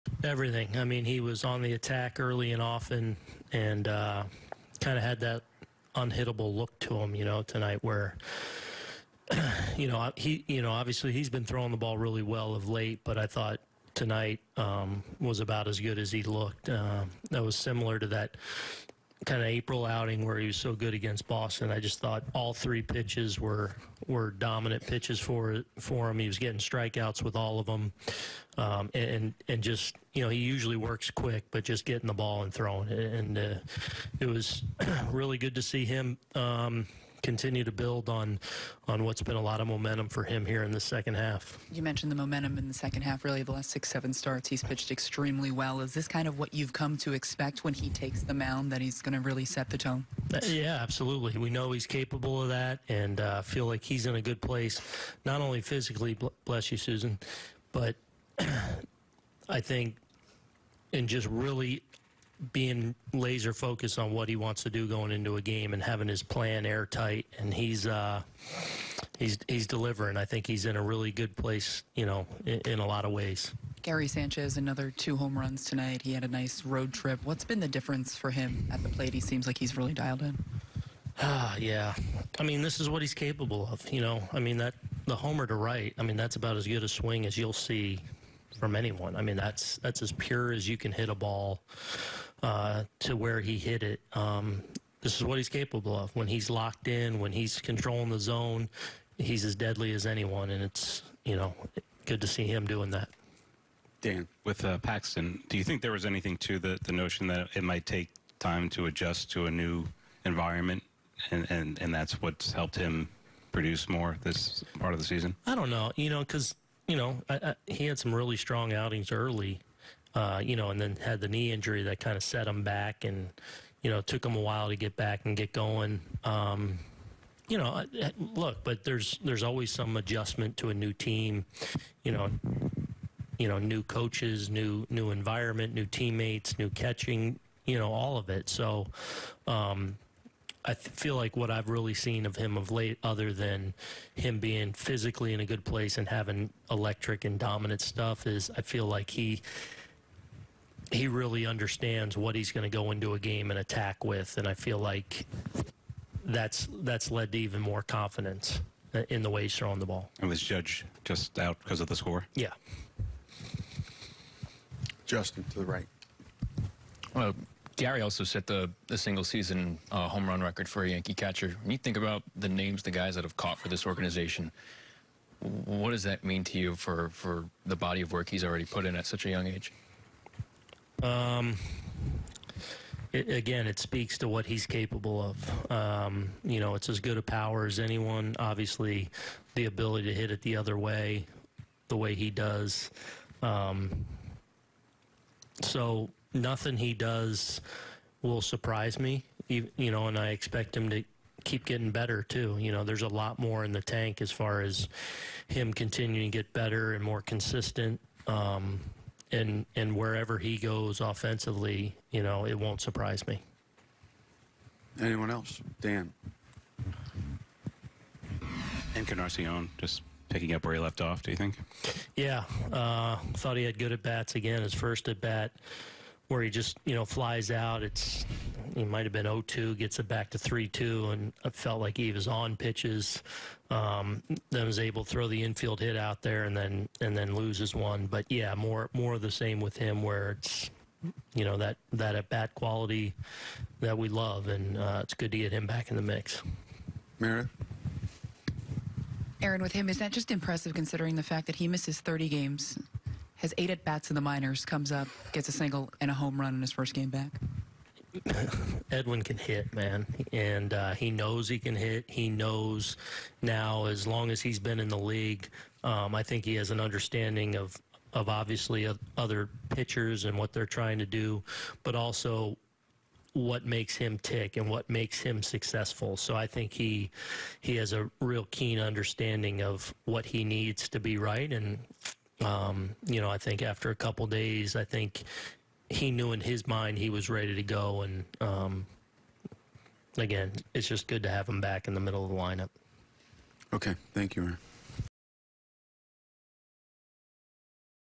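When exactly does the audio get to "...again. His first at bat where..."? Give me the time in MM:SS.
03:44.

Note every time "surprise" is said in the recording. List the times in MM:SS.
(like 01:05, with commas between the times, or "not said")
03:18, 03:32.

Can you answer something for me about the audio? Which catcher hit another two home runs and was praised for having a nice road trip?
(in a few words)
Gary Sanchez.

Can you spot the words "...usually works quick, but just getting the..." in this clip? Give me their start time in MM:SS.
00:30.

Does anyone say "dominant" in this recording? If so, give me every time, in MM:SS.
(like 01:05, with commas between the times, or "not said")
00:24, 02:27.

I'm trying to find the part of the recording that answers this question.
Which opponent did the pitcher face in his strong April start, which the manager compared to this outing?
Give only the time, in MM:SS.
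00:21.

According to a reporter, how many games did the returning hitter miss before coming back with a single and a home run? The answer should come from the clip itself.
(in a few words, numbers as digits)
30.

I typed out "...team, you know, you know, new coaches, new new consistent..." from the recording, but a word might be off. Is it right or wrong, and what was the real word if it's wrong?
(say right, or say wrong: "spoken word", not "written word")
wrong: "environment", not "consistent".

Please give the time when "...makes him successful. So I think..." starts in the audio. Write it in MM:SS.
04:34.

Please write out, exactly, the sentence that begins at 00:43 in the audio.
Really, the last six, seven starts, he's pitched extremely well.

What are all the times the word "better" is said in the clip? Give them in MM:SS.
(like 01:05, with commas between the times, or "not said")
03:21, 03:26.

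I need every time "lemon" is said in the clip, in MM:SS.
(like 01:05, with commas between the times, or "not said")
not said.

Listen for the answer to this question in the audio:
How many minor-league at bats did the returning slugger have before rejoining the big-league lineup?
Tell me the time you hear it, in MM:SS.
04:13.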